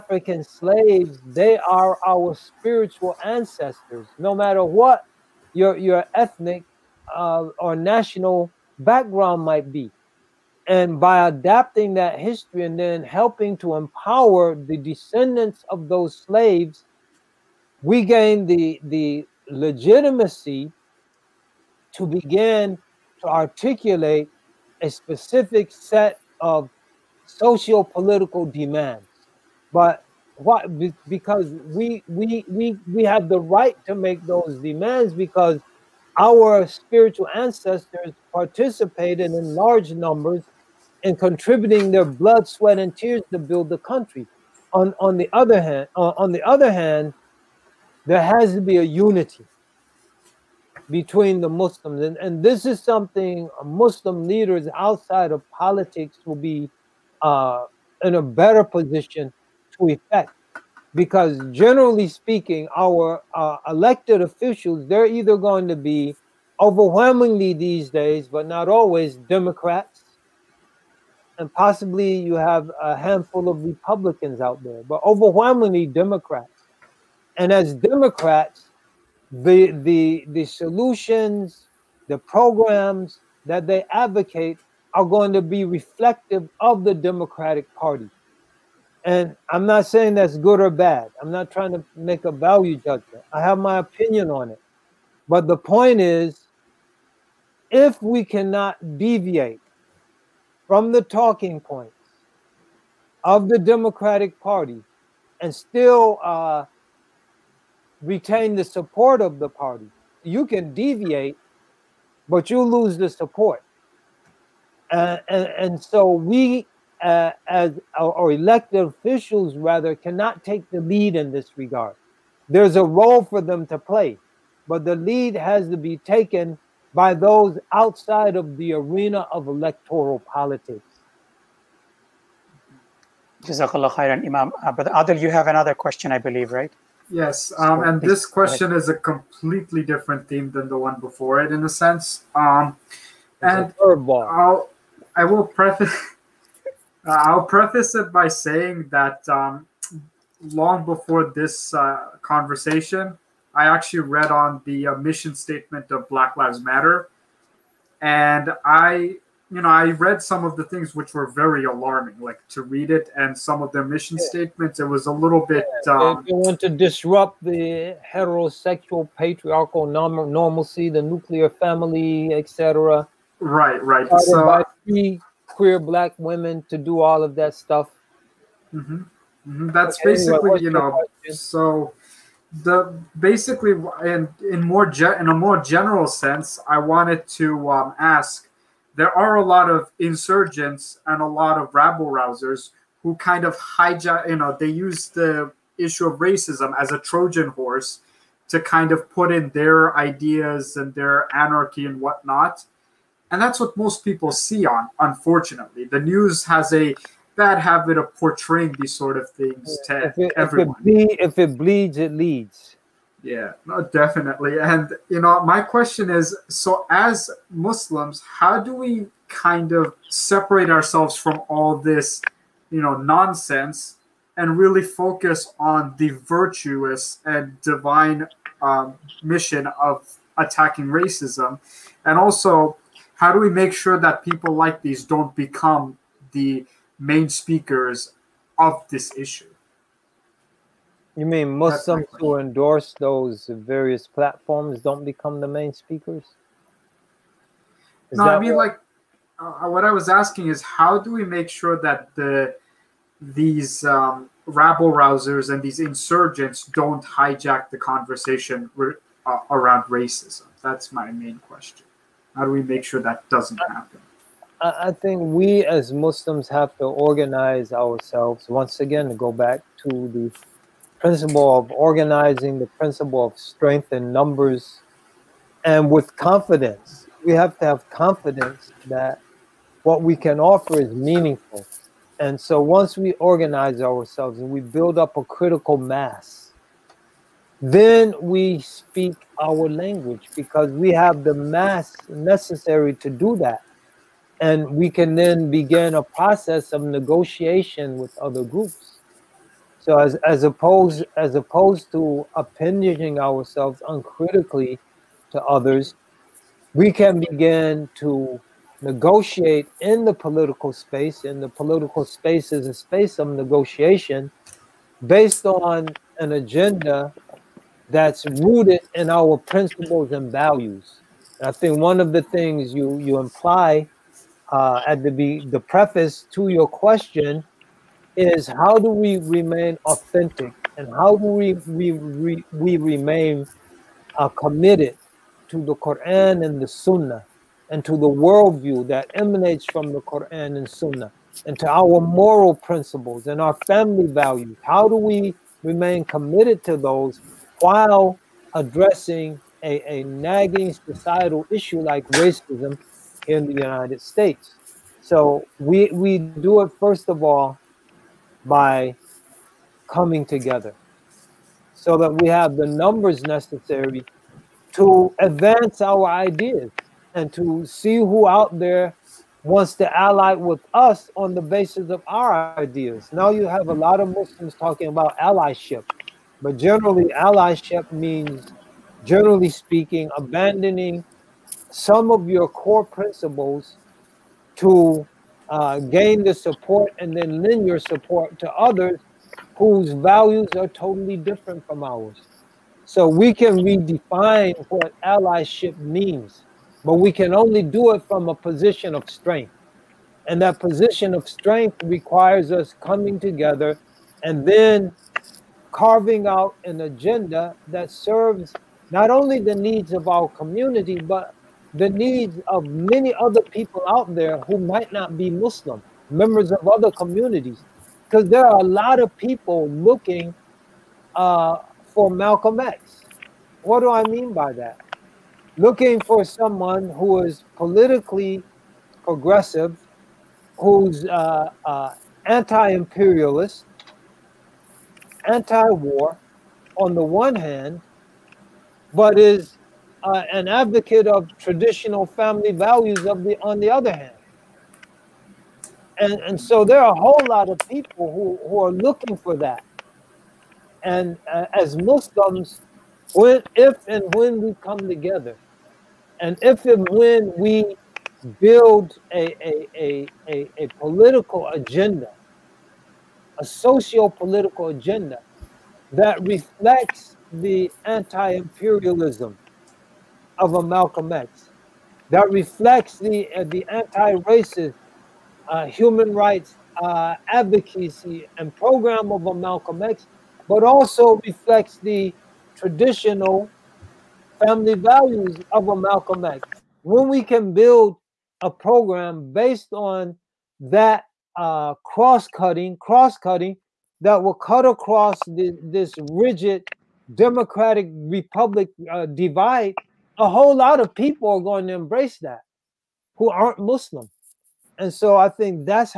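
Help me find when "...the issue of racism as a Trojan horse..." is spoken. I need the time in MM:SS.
03:15.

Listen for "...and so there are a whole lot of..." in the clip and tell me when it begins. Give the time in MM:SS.
07:26.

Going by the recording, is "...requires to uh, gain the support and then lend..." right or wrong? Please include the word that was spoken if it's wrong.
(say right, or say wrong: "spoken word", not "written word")
wrong: "principles", not "requires".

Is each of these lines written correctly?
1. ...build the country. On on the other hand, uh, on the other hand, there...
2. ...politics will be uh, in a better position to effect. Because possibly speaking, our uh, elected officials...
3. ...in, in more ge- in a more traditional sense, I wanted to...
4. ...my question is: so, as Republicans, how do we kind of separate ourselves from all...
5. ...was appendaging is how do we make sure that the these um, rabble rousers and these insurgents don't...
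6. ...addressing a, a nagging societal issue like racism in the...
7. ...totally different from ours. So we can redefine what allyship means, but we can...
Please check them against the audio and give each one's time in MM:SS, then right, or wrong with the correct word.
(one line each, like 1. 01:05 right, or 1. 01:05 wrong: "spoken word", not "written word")
1. 00:43 right
2. 00:55 wrong: "generally", not "possibly"
3. 03:04 wrong: "general", not "traditional"
4. 03:35 wrong: "Muslims", not "Republicans"
5. 04:09 wrong: "asking", not "appendaging"
6. 05:48 right
7. 06:30 right.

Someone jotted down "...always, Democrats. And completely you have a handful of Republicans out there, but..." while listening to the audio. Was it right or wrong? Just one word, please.
wrong.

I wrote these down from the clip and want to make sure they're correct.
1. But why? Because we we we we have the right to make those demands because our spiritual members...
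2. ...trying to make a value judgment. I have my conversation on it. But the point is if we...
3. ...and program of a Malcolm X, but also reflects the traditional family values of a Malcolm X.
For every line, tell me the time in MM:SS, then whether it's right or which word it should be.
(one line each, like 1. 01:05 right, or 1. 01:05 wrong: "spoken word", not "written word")
1. 00:29 wrong: "ancestors", not "members"
2. 01:31 wrong: "opinion", not "conversation"
3. 07:58 right.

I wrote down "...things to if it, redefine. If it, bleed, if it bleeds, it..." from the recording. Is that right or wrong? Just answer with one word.
wrong.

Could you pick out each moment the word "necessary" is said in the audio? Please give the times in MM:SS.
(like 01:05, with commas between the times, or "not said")
04:52, 06:03.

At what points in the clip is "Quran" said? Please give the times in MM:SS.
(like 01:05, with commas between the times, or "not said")
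05:35, 05:40.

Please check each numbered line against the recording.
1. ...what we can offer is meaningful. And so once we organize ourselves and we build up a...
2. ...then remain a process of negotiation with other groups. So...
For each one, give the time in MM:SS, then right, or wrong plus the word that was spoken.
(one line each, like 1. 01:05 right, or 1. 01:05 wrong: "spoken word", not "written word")
1. 04:39 right
2. 04:55 wrong: "begin", not "remain".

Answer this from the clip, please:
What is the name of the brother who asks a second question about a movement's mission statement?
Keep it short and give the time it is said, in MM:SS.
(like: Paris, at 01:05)
Adil, at 02:14.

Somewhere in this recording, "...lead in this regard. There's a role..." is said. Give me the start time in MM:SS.
02:00.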